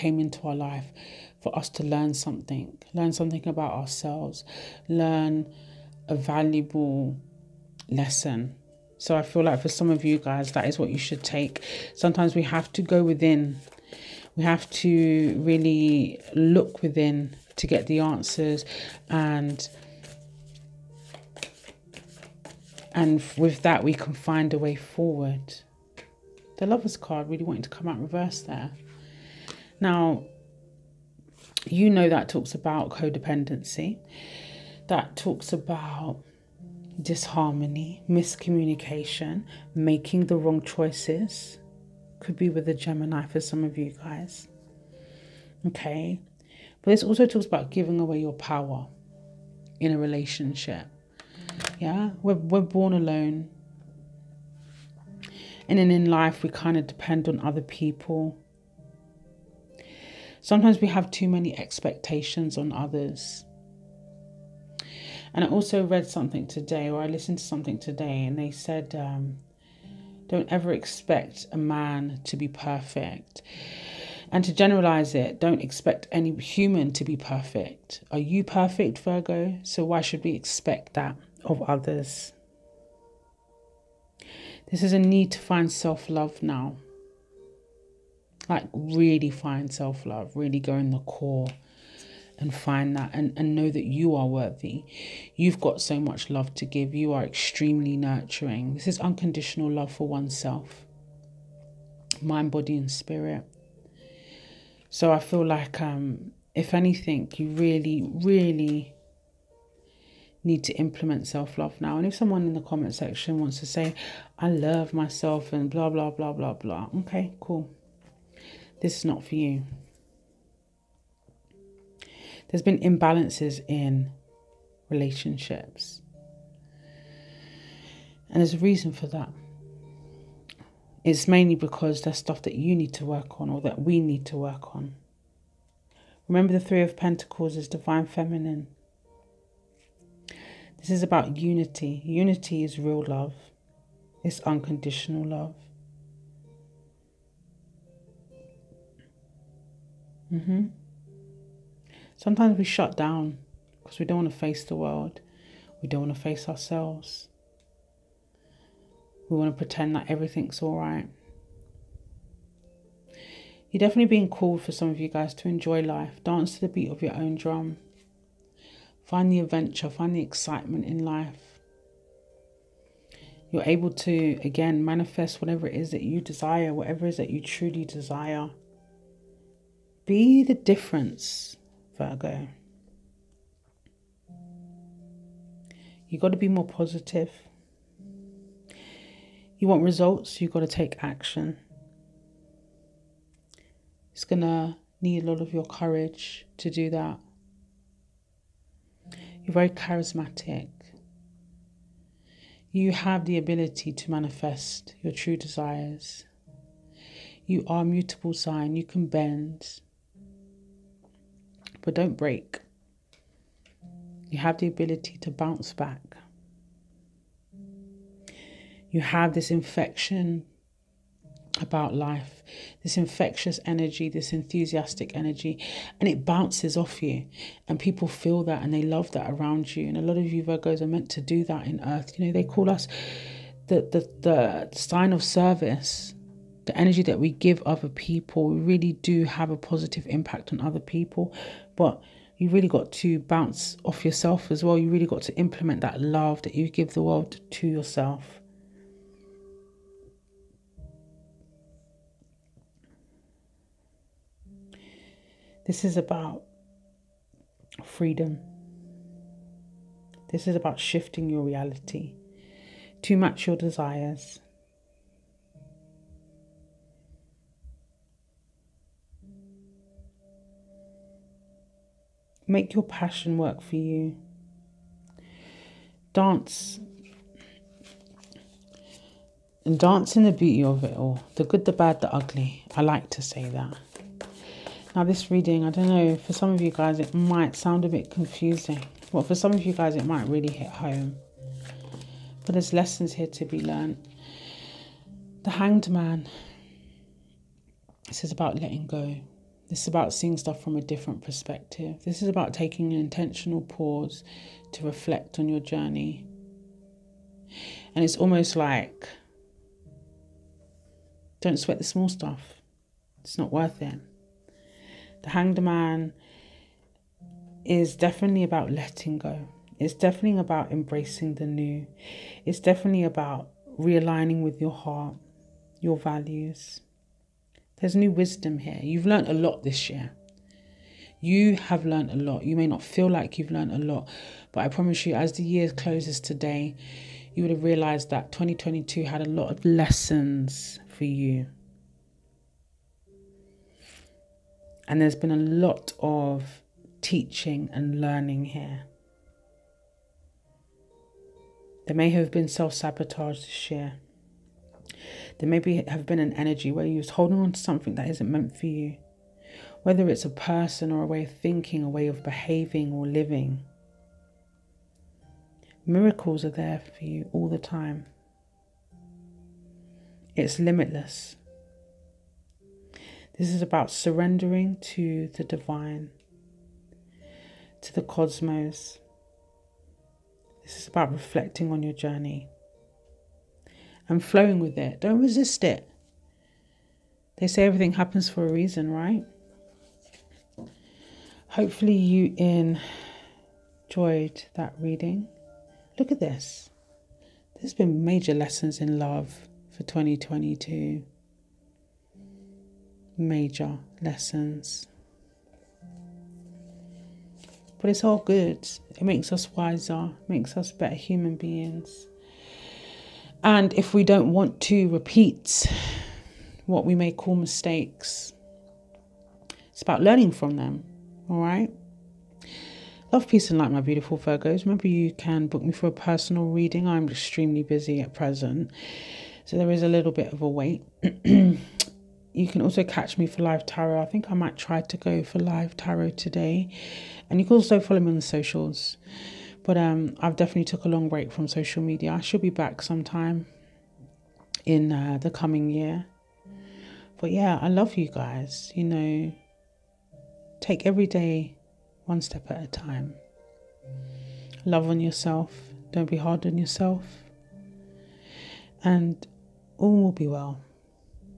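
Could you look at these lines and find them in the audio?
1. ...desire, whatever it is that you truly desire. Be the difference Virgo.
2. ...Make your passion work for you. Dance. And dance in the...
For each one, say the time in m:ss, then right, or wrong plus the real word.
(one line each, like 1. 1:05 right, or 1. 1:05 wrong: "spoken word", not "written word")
1. 2:56 right
2. 4:32 right.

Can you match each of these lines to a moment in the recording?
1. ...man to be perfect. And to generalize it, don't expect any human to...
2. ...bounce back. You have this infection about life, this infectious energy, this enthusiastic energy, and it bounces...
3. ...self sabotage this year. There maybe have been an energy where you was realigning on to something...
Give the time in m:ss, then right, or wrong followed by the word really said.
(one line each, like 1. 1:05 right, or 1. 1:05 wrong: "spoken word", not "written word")
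1. 1:11 right
2. 3:35 right
3. 5:52 wrong: "holding", not "realigning".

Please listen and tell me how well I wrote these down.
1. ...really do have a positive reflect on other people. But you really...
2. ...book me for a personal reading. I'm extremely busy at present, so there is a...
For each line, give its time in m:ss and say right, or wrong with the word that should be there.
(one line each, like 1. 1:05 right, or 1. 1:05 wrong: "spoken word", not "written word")
1. 3:58 wrong: "impact", not "reflect"
2. 7:05 right.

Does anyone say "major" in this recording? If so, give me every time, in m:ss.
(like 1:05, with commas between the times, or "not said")
6:38, 6:43.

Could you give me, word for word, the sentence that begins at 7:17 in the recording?
And you can also follow me on the socials.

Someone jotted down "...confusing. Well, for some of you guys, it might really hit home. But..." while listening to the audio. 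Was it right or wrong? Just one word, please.
right.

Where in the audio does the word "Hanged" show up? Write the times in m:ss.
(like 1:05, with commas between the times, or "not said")
4:55, 5:15.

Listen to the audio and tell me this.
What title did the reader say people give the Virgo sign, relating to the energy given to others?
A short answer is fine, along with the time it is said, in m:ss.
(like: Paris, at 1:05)
sign of service, at 3:54.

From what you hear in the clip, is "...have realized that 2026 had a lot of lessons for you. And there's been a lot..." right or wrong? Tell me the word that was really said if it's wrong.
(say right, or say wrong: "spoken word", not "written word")
wrong: "2022", not "2026".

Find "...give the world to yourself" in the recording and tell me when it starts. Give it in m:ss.
4:06.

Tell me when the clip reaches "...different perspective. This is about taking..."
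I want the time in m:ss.
5:00.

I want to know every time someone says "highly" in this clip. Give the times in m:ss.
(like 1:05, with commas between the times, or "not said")
not said.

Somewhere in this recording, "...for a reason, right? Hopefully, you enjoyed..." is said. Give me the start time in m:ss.
6:28.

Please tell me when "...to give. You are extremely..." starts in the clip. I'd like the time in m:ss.
1:36.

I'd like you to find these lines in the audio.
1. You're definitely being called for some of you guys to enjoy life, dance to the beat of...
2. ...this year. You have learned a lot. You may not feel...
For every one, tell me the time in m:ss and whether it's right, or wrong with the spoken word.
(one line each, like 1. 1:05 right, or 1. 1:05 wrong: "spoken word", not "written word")
1. 2:43 right
2. 5:29 right.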